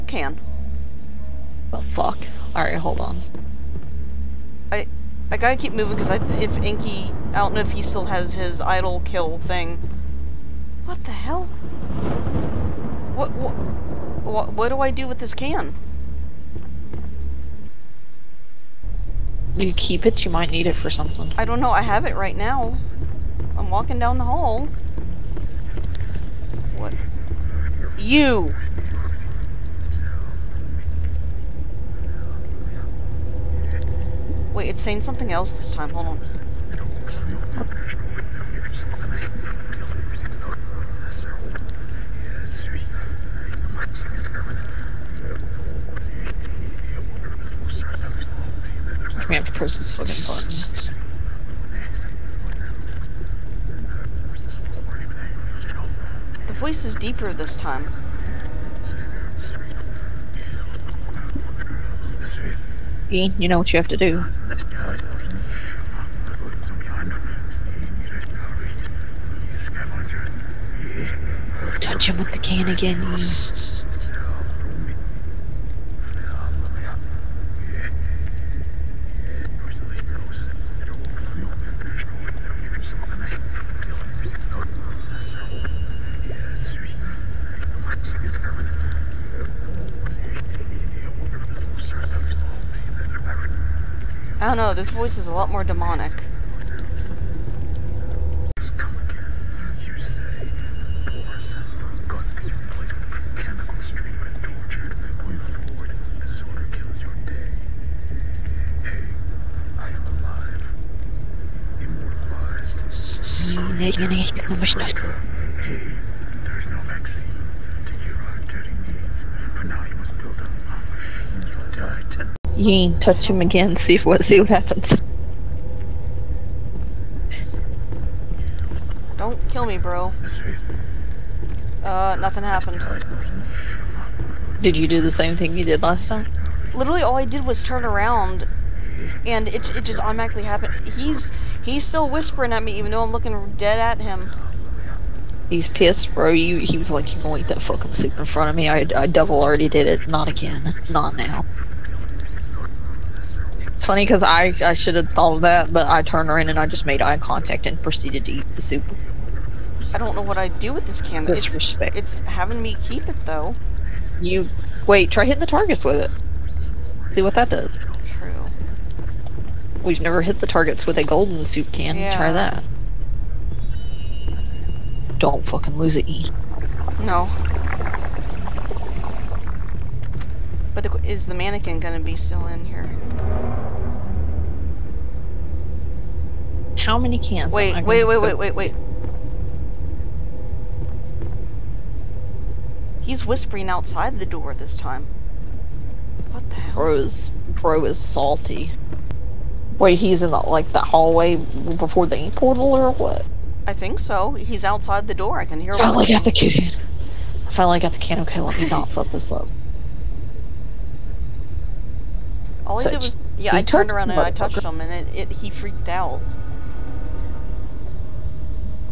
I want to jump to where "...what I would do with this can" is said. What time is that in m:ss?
2:40.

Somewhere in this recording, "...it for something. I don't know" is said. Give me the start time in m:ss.
0:20.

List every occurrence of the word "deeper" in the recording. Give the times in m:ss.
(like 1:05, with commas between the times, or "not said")
0:56.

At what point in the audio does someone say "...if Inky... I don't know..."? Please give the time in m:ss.
0:06.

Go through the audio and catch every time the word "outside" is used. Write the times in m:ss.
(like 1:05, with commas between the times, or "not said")
3:13, 3:24.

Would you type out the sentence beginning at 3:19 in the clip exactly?
Wait, he's in the, like the hallway before the ink portal or what?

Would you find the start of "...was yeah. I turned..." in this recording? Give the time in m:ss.
3:32.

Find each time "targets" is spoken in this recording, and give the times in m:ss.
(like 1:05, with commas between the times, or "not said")
2:45, 2:50.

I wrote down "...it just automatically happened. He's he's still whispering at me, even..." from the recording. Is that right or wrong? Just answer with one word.
right.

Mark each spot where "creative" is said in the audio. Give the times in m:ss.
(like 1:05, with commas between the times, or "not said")
not said.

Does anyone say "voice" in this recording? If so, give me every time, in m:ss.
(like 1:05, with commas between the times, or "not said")
0:56, 1:34.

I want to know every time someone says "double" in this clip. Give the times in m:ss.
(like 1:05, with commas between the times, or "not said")
2:29.